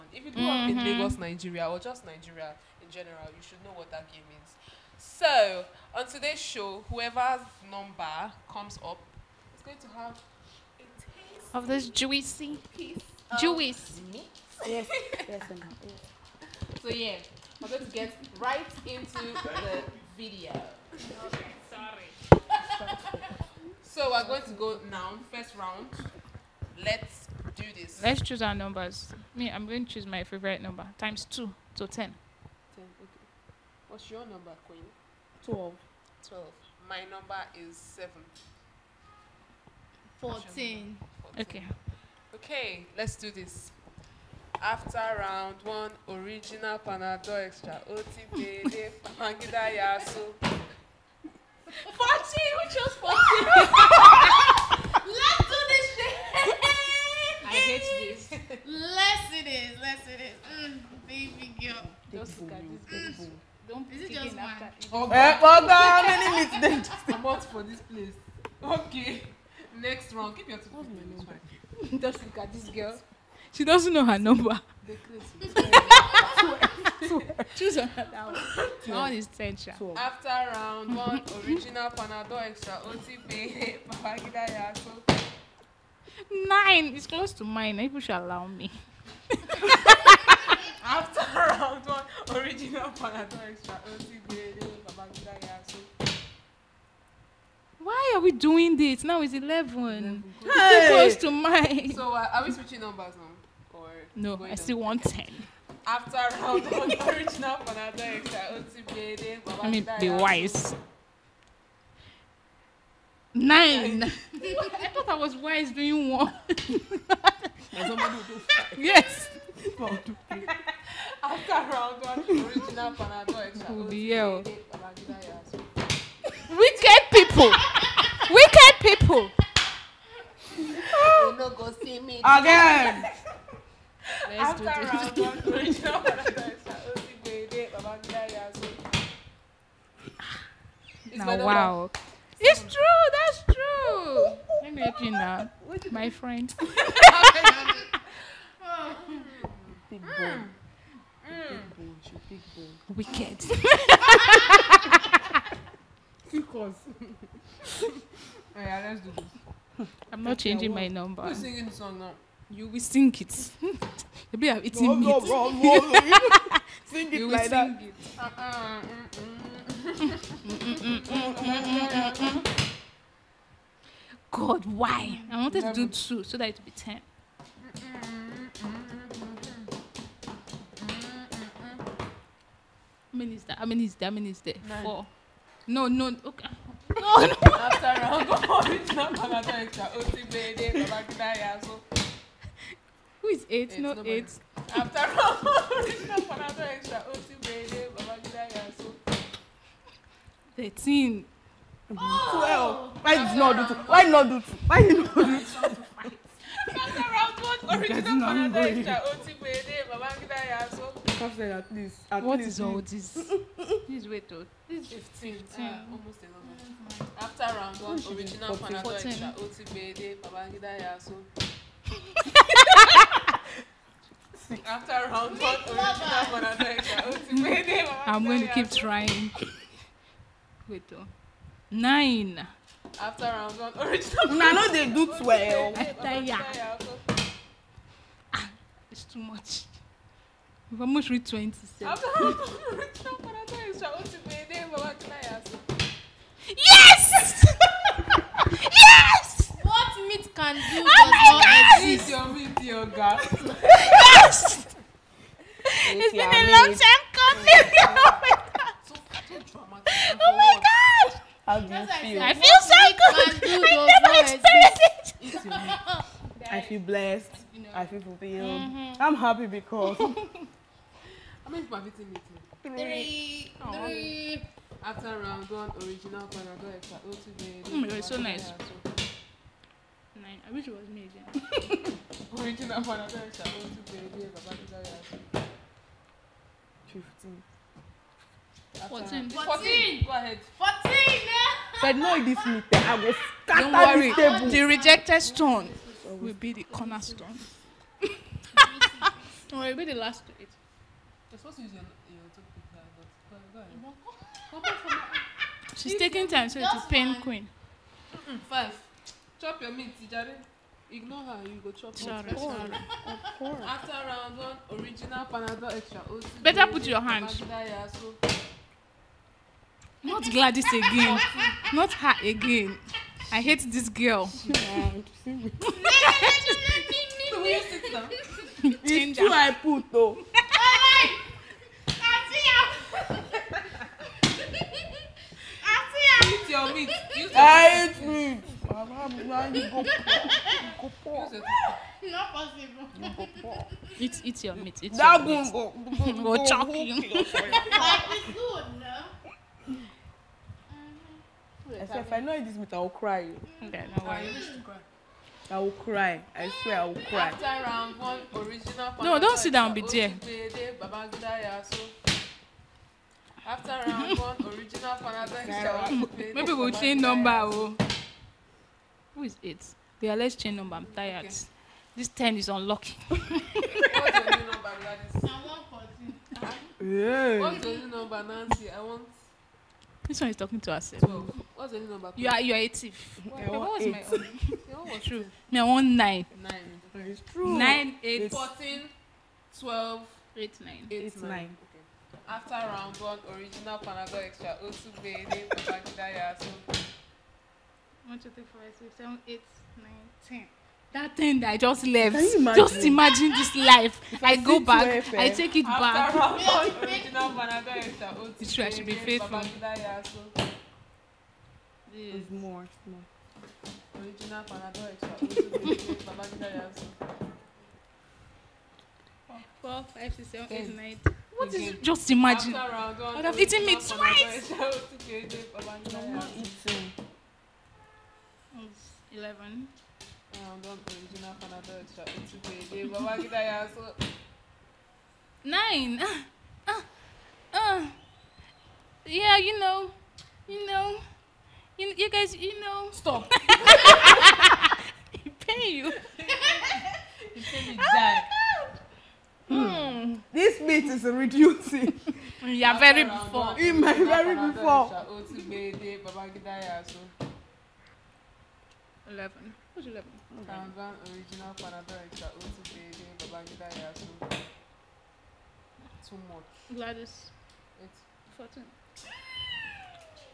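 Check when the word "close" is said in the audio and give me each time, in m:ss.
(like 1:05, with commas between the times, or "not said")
1:27, 1:40.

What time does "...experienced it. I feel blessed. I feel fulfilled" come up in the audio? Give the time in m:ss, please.
4:24.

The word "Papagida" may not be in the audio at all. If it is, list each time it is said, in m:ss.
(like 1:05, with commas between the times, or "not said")
1:23, 1:34.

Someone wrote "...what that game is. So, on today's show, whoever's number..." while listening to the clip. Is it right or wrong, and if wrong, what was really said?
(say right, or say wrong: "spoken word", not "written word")
right.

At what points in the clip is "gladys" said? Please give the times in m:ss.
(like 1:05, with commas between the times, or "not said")
5:20, 7:46.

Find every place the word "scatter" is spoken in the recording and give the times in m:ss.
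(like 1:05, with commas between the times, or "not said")
4:53.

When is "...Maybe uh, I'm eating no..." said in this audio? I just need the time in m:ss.
2:44.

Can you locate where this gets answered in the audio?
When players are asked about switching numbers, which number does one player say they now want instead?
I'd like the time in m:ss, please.
6:25.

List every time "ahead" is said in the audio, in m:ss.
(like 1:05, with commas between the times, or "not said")
4:50, 5:04.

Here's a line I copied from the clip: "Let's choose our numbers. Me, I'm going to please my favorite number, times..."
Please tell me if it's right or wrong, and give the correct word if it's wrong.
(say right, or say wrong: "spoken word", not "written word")
wrong: "choose", not "please".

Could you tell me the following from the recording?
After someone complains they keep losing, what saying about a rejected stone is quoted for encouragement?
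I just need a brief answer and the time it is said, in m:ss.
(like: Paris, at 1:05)
The rejected stone will be the cornerstone, at 4:54.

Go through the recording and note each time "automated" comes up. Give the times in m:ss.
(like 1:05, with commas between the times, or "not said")
not said.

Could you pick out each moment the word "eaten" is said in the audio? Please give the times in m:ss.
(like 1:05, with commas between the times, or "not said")
4:31, 7:03.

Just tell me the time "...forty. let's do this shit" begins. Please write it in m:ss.
0:53.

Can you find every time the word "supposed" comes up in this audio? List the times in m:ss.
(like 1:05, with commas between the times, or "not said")
5:01.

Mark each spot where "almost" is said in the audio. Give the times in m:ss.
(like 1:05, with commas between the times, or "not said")
3:35, 4:00.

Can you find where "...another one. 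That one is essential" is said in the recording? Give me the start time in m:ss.
1:17.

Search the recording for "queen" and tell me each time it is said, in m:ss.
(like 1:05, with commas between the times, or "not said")
0:34, 5:07.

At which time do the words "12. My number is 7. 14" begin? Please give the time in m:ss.
0:36.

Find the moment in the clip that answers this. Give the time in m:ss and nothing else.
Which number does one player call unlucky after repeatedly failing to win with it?
6:11.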